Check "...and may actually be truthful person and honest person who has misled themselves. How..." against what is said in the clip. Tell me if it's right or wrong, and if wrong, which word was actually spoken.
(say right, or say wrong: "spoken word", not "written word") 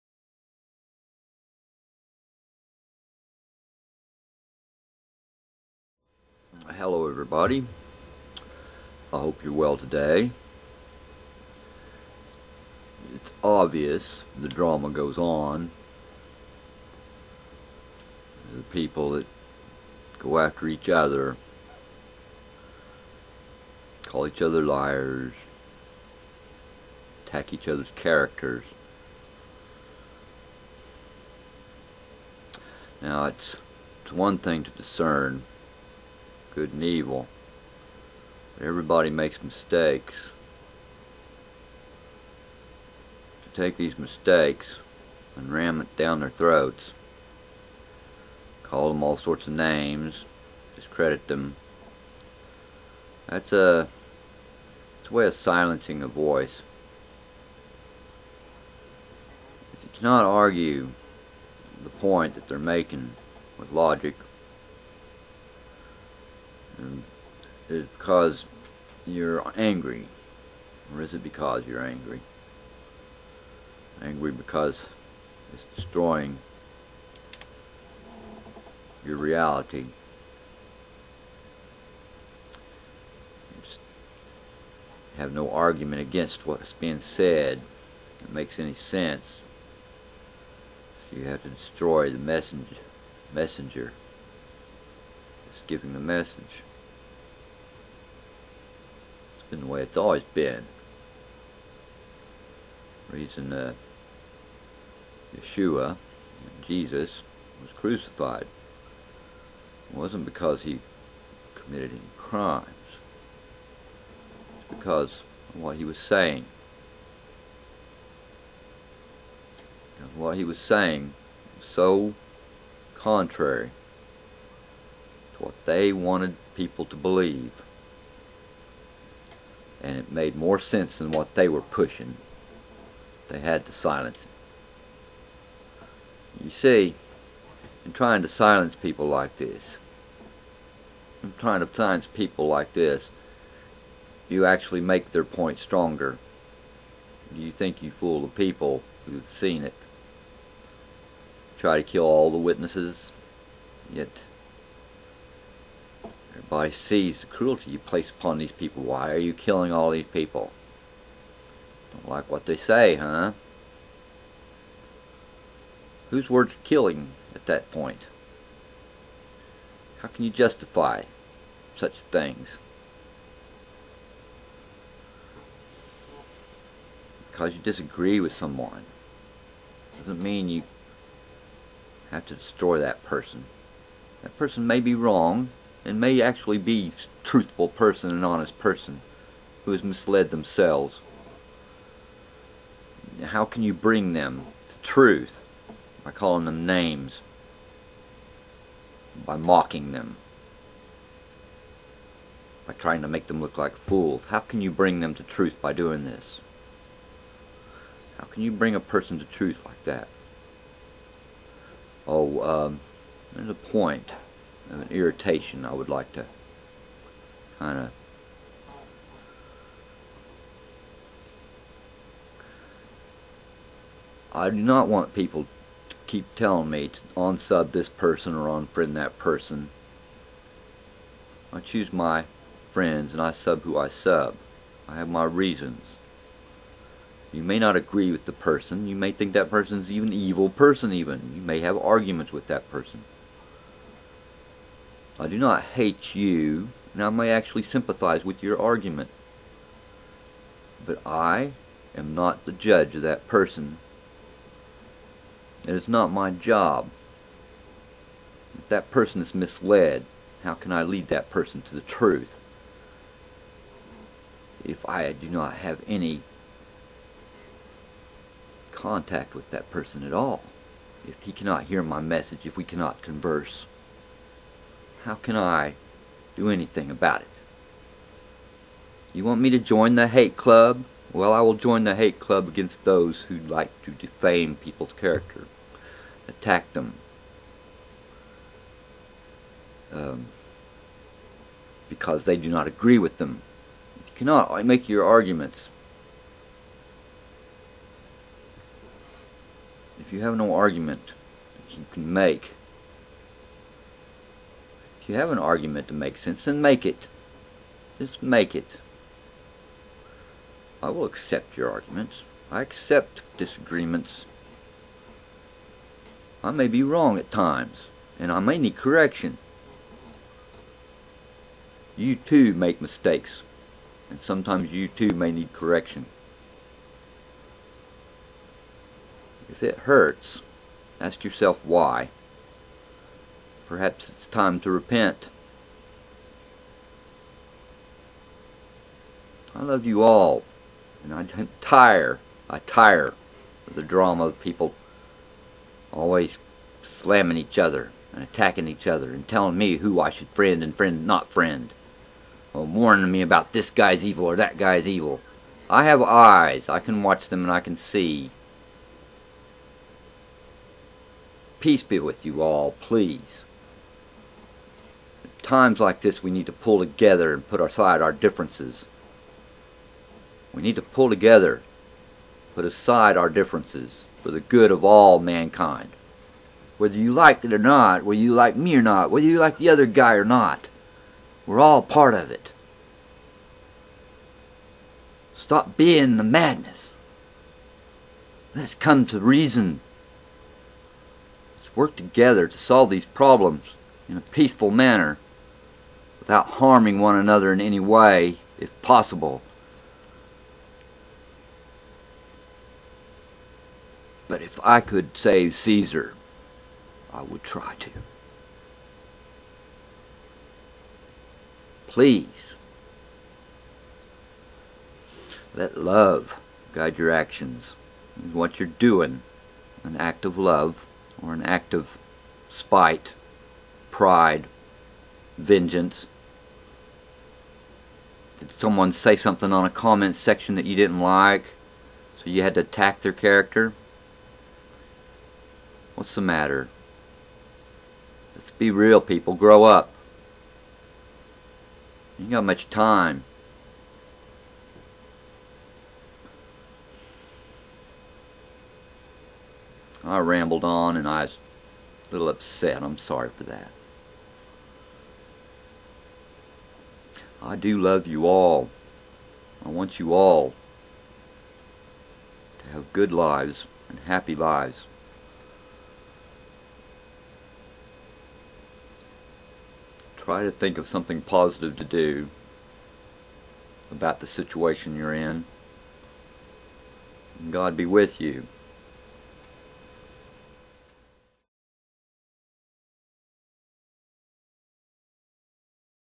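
right.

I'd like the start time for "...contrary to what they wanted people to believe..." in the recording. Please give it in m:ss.
2:02.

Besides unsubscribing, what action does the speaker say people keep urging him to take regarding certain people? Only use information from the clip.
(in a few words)
unfriend.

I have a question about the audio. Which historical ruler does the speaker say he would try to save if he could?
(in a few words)
Caesar.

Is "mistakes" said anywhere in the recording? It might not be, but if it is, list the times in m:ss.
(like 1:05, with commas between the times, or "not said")
0:39, 0:43, 5:22.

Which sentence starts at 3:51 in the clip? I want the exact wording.
I choose my friends and I sub who I sub.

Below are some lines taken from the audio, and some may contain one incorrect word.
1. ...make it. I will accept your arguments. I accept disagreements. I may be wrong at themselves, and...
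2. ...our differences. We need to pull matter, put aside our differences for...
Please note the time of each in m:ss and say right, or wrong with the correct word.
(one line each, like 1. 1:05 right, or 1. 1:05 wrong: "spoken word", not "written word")
1. 5:08 wrong: "times", not "themselves"
2. 6:08 wrong: "together", not "matter".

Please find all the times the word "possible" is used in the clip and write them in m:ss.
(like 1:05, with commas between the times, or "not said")
6:38.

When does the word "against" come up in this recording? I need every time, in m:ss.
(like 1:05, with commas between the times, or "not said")
1:26, 4:42.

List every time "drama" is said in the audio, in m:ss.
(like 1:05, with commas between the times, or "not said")
0:14, 5:43.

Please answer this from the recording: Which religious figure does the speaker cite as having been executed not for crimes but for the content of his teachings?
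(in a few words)
Yeshua.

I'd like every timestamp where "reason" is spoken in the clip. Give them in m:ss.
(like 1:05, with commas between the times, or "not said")
1:43, 3:55, 6:29.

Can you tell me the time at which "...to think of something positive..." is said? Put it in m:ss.
7:50.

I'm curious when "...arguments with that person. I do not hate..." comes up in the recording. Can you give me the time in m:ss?
4:01.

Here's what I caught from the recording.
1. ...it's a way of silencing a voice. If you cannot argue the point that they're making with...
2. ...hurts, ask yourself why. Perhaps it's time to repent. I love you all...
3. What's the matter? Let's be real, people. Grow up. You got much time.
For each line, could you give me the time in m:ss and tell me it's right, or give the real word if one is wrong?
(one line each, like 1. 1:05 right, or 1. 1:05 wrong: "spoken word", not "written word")
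1. 0:55 right
2. 5:29 right
3. 7:15 right.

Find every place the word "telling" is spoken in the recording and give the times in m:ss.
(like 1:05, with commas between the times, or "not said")
3:46, 5:49.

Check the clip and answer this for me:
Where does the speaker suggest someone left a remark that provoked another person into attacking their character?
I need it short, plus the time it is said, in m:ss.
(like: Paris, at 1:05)
comment section, at 7:09.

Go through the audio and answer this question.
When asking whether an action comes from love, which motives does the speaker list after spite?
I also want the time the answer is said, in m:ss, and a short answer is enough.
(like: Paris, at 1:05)
pride, vengeance, at 7:03.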